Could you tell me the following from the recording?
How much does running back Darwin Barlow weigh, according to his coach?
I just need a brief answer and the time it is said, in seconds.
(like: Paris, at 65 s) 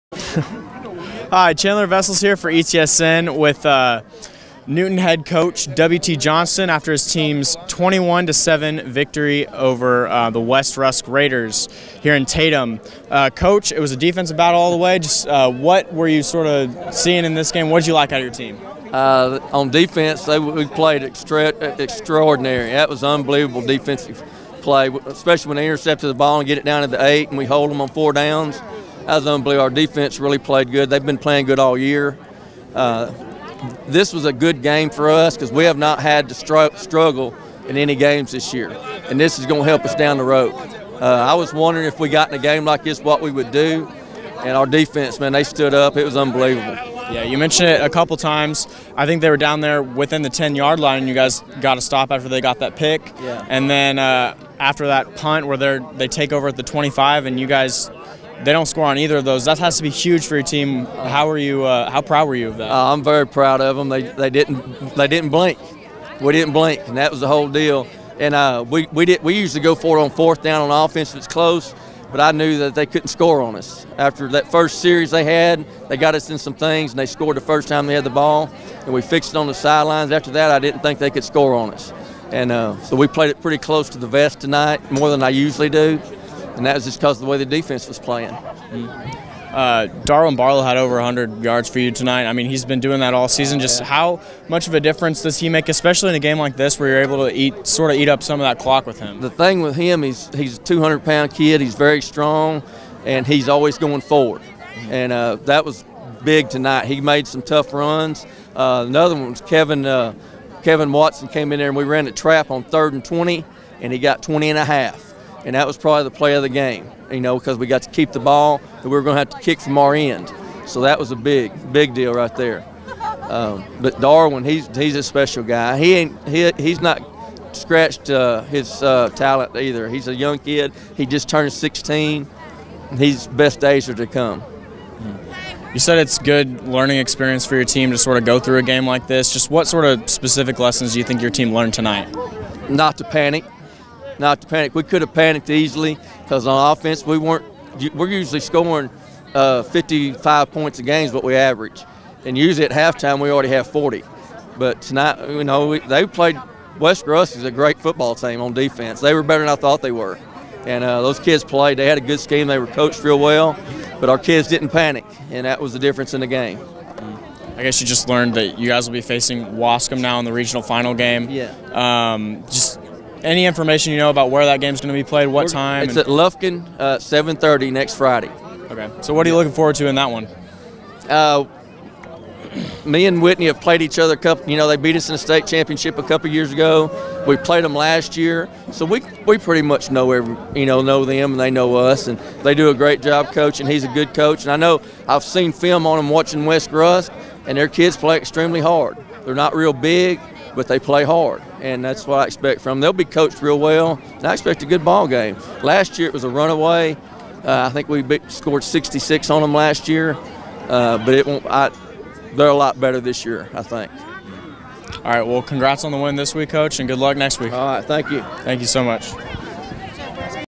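200 pounds, at 100 s.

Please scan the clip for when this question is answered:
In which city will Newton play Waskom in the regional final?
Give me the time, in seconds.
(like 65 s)
176 s.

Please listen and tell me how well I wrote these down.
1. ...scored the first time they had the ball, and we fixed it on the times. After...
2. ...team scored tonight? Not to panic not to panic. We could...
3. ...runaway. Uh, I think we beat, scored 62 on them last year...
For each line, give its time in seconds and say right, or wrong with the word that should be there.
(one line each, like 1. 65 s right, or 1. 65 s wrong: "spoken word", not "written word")
1. 77 s wrong: "sidelines", not "times"
2. 141 s wrong: "learned", not "scored"
3. 206 s wrong: "66", not "62".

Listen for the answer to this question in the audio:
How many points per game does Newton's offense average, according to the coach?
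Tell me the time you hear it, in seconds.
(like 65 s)
149 s.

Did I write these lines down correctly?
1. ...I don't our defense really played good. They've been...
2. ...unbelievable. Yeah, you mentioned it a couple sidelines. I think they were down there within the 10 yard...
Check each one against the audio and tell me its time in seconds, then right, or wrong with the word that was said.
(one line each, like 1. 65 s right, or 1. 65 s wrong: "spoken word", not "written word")
1. 29 s right
2. 46 s wrong: "times", not "sidelines".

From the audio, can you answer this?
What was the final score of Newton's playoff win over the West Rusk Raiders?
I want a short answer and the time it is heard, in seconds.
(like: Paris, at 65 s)
21-7, at 7 s.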